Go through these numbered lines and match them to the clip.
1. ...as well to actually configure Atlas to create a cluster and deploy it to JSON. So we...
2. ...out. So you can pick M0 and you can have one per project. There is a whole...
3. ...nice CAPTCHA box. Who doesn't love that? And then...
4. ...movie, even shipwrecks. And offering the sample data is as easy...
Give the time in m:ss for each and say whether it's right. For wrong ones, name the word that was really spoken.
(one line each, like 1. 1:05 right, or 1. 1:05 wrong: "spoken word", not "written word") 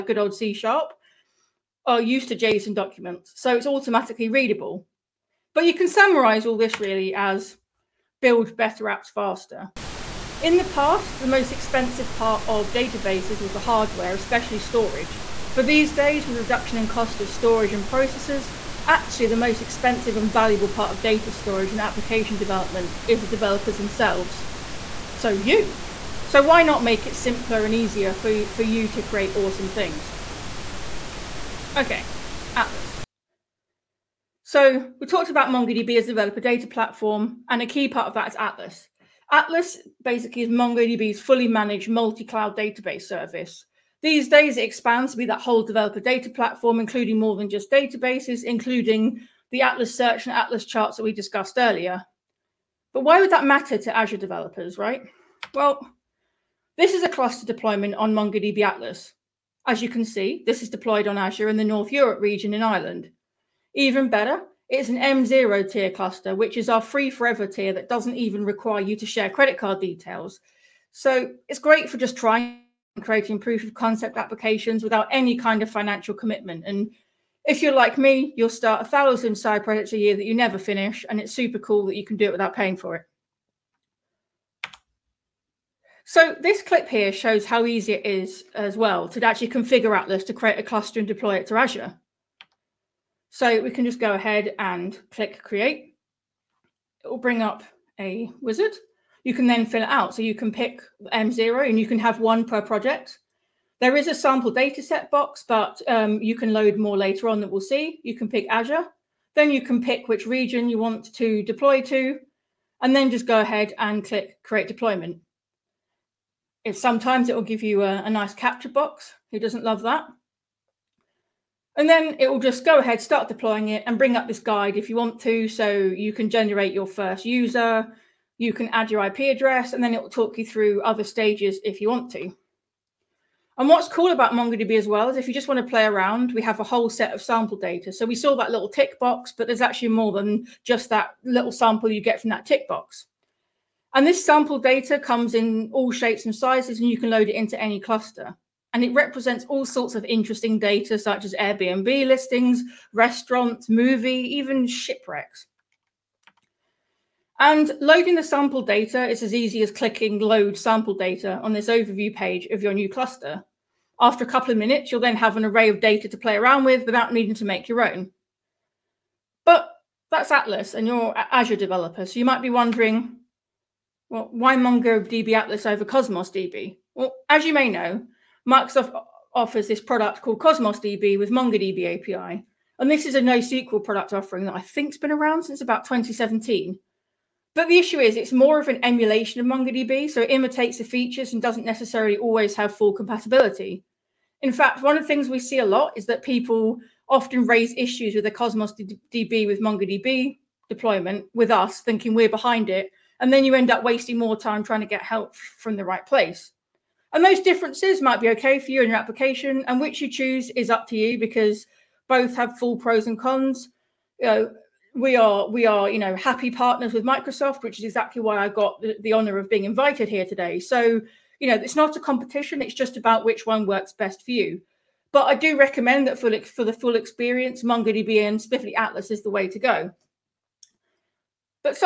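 1. 1:28 wrong: "Azure", not "JSON"
2. 1:39 wrong: "sample", not "whole"
3. 1:58 right
4. 2:33 wrong: "loading", not "offering".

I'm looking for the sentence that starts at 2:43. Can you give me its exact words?
After a couple of minutes, you'll then have an array of data to play around with without needing to make your own.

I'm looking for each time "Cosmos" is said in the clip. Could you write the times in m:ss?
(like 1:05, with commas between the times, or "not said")
2:55, 3:00, 3:18.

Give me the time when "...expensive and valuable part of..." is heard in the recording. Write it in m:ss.
0:19.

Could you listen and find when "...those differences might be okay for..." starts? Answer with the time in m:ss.
3:27.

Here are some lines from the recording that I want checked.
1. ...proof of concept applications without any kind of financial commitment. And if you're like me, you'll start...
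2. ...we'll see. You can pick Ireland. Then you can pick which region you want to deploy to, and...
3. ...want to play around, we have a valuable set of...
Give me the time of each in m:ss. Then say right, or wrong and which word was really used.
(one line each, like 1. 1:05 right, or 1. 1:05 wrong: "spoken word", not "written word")
1. 1:13 right
2. 1:47 wrong: "Azure", not "Ireland"
3. 2:15 wrong: "whole", not "valuable".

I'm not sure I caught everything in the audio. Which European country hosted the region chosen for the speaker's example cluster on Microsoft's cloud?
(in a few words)
Ireland.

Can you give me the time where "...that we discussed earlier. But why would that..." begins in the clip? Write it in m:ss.
0:50.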